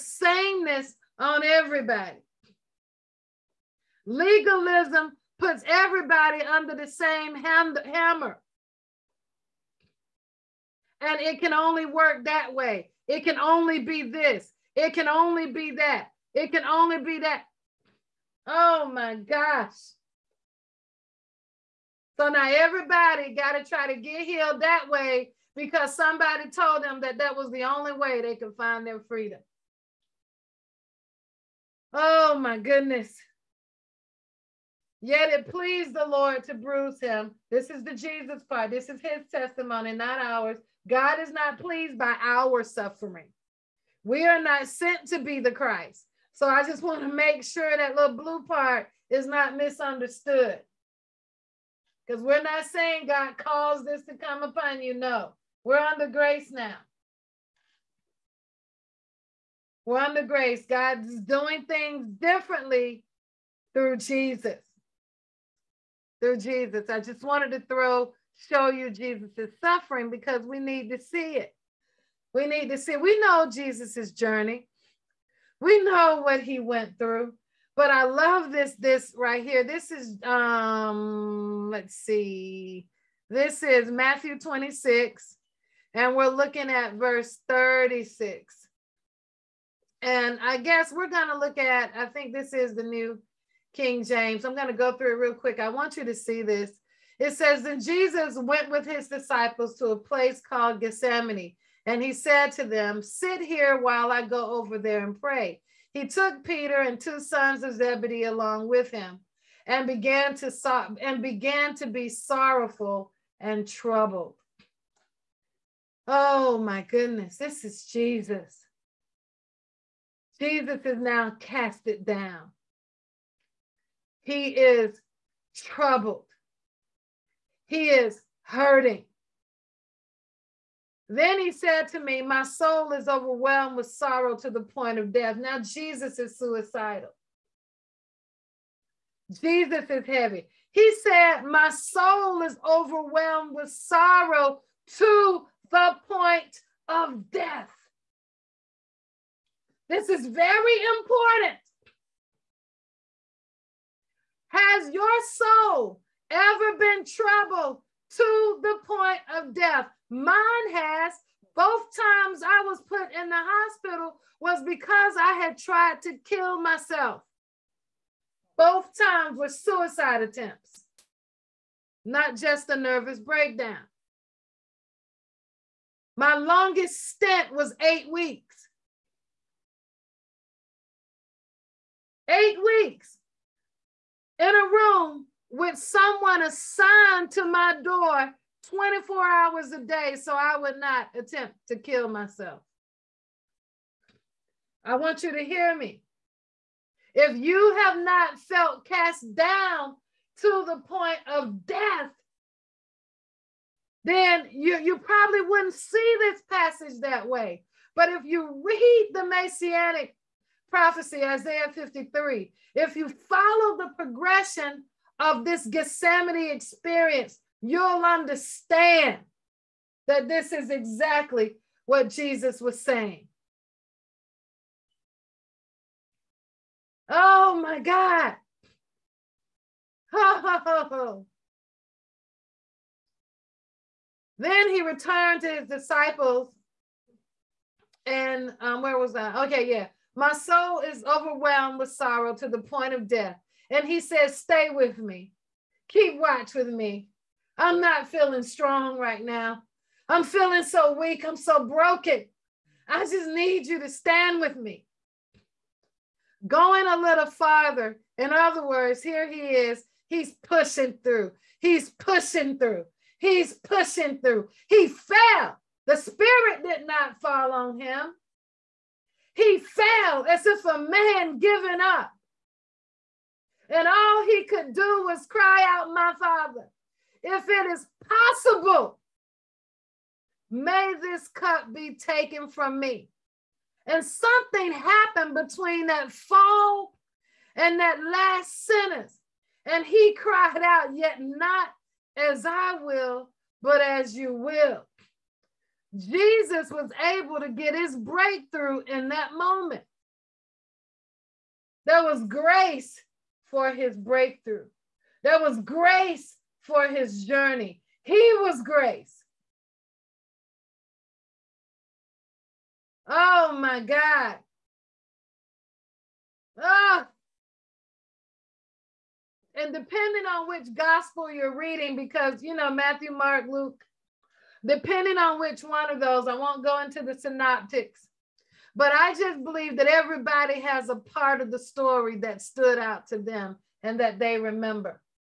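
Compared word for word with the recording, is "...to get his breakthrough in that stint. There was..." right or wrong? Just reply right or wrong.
wrong.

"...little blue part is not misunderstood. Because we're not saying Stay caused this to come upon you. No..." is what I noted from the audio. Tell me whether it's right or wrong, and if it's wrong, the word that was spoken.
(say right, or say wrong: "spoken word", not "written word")
wrong: "God", not "Stay".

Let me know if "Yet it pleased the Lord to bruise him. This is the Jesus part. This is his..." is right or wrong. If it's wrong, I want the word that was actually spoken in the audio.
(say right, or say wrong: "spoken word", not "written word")
right.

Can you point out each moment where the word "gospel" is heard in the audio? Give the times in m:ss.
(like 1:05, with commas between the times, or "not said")
5:20.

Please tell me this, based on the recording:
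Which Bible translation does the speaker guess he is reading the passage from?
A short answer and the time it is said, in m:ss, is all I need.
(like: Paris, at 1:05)
New King James, at 1:32.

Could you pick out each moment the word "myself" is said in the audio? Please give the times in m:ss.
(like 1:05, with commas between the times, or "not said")
2:46, 3:12.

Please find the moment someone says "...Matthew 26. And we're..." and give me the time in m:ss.
1:23.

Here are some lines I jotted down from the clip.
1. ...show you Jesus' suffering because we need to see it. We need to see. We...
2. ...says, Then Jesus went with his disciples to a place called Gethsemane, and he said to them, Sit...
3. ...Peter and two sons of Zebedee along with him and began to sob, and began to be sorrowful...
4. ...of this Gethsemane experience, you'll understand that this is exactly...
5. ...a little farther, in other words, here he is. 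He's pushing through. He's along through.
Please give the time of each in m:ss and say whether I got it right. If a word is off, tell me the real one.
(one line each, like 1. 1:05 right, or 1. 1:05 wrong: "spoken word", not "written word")
1. 1:08 right
2. 1:37 right
3. 1:46 right
4. 3:35 right
5. 4:16 wrong: "pushing", not "along".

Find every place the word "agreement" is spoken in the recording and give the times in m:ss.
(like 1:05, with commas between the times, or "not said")
not said.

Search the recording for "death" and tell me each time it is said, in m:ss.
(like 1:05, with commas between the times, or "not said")
2:15, 2:27, 2:39, 3:21, 4:03.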